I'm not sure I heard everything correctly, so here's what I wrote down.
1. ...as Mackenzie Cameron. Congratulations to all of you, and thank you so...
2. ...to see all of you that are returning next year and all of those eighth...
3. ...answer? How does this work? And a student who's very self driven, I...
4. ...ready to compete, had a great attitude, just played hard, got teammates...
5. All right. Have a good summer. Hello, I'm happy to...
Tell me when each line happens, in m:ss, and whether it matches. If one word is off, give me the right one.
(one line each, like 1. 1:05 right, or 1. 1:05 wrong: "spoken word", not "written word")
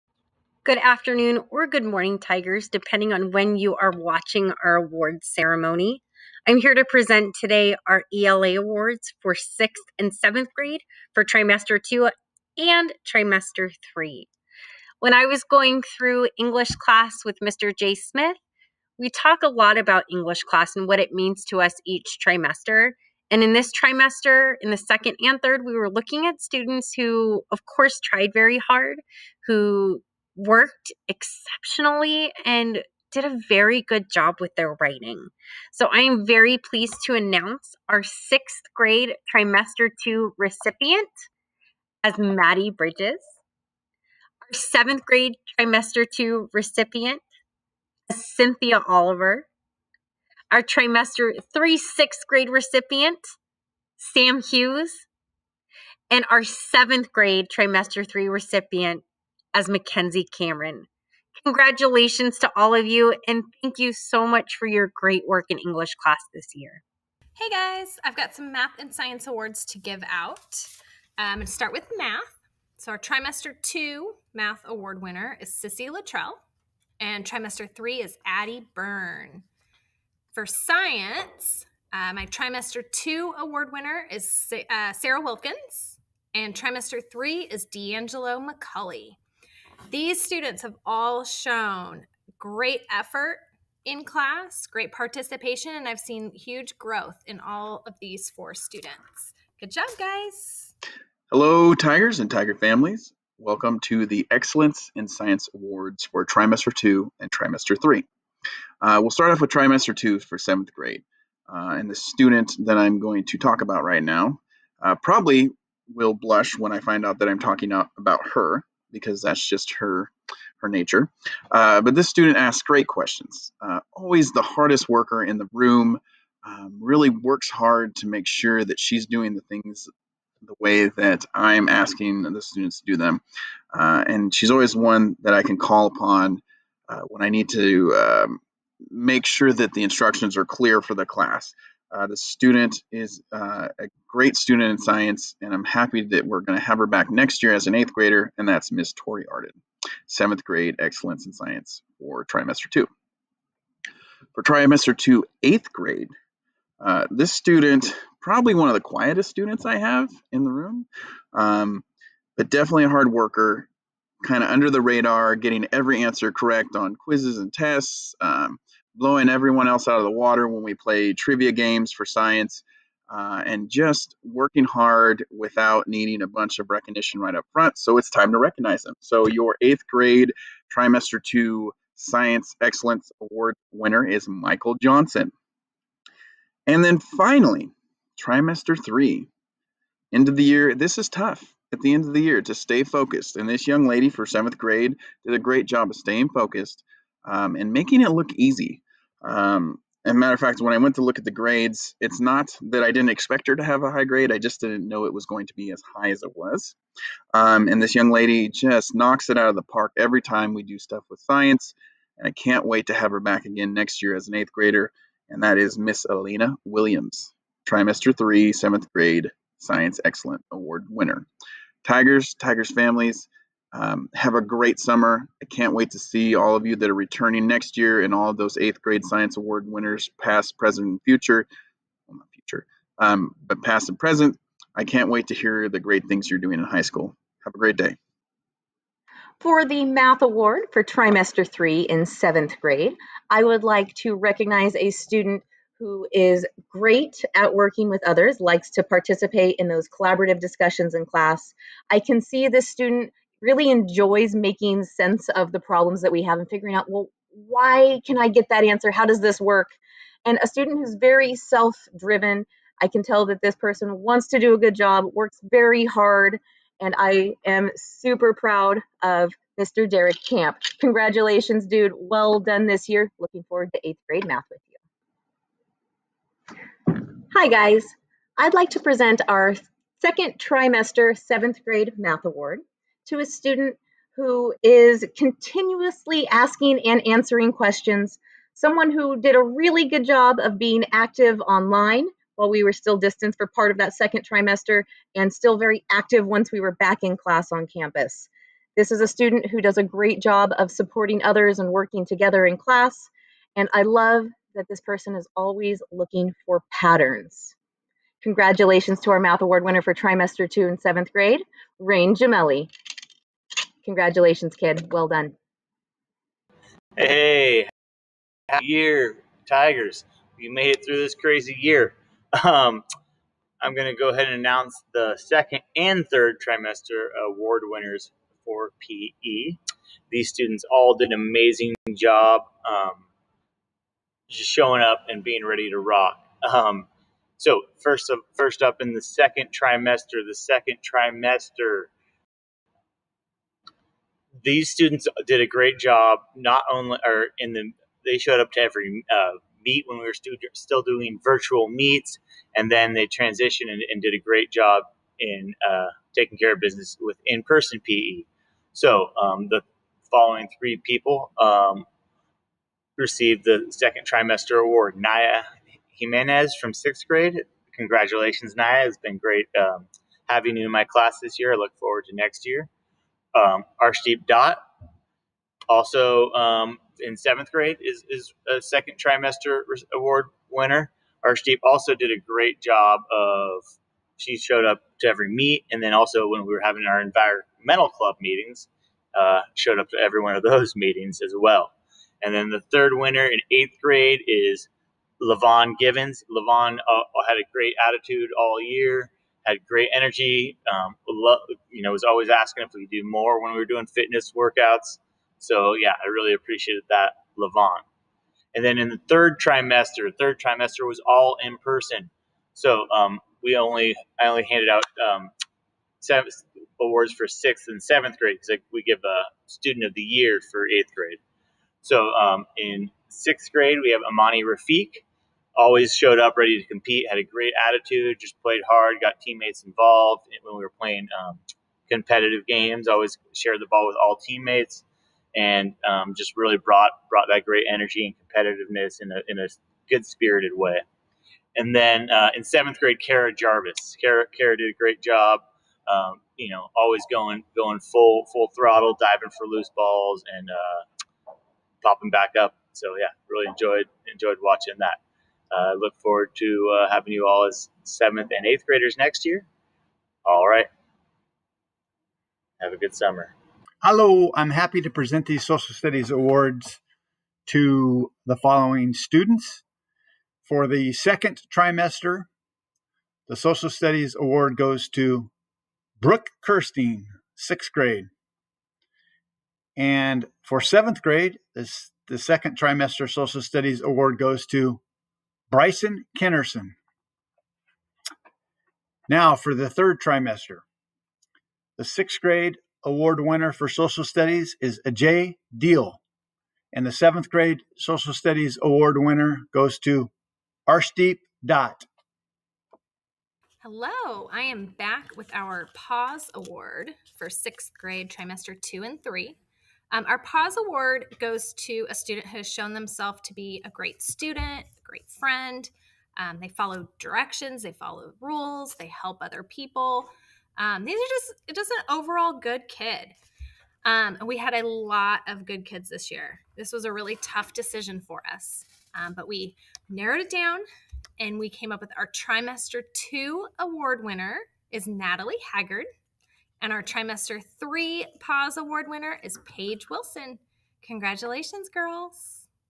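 1. 0:59 right
2. 3:45 right
3. 4:18 right
4. 7:06 right
5. 7:40 right.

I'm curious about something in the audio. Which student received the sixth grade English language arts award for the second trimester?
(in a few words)
Maddie Bridges.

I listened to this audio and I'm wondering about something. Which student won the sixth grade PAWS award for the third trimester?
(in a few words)
Paige Wilson.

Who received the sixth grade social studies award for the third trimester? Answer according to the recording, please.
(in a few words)
Ajay Deal.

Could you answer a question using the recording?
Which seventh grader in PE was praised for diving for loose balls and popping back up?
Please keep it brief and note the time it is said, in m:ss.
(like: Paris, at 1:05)
Kara Jarvis, at 7:23.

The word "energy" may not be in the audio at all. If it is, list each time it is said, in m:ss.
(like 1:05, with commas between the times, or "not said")
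6:39, 7:17.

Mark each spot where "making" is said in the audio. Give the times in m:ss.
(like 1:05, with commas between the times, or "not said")
3:17, 4:14.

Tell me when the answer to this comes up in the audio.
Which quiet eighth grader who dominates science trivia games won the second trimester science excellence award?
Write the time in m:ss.
3:04.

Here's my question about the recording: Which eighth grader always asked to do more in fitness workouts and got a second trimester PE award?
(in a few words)
Levon Givens.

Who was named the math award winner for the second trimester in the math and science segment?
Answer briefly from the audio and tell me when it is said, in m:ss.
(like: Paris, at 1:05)
Sissy Luttrell, at 1:15.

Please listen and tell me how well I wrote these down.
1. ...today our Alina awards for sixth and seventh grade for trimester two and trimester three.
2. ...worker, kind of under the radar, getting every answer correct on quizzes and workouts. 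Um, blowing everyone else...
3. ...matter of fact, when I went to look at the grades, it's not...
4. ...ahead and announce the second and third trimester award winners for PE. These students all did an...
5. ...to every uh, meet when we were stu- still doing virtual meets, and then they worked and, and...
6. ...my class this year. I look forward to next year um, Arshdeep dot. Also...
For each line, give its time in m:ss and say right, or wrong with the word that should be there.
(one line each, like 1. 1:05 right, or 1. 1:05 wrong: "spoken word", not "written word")
1. 0:07 wrong: "ELA", not "Alina"
2. 2:43 wrong: "tests", not "workouts"
3. 3:20 right
4. 5:24 right
5. 5:48 wrong: "transitioned", not "worked"
6. 6:10 right.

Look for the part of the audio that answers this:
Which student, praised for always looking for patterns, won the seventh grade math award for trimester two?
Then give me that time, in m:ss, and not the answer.
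5:11.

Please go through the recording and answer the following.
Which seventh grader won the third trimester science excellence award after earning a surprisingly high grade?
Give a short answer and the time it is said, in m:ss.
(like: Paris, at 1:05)
Alina Williams, at 3:36.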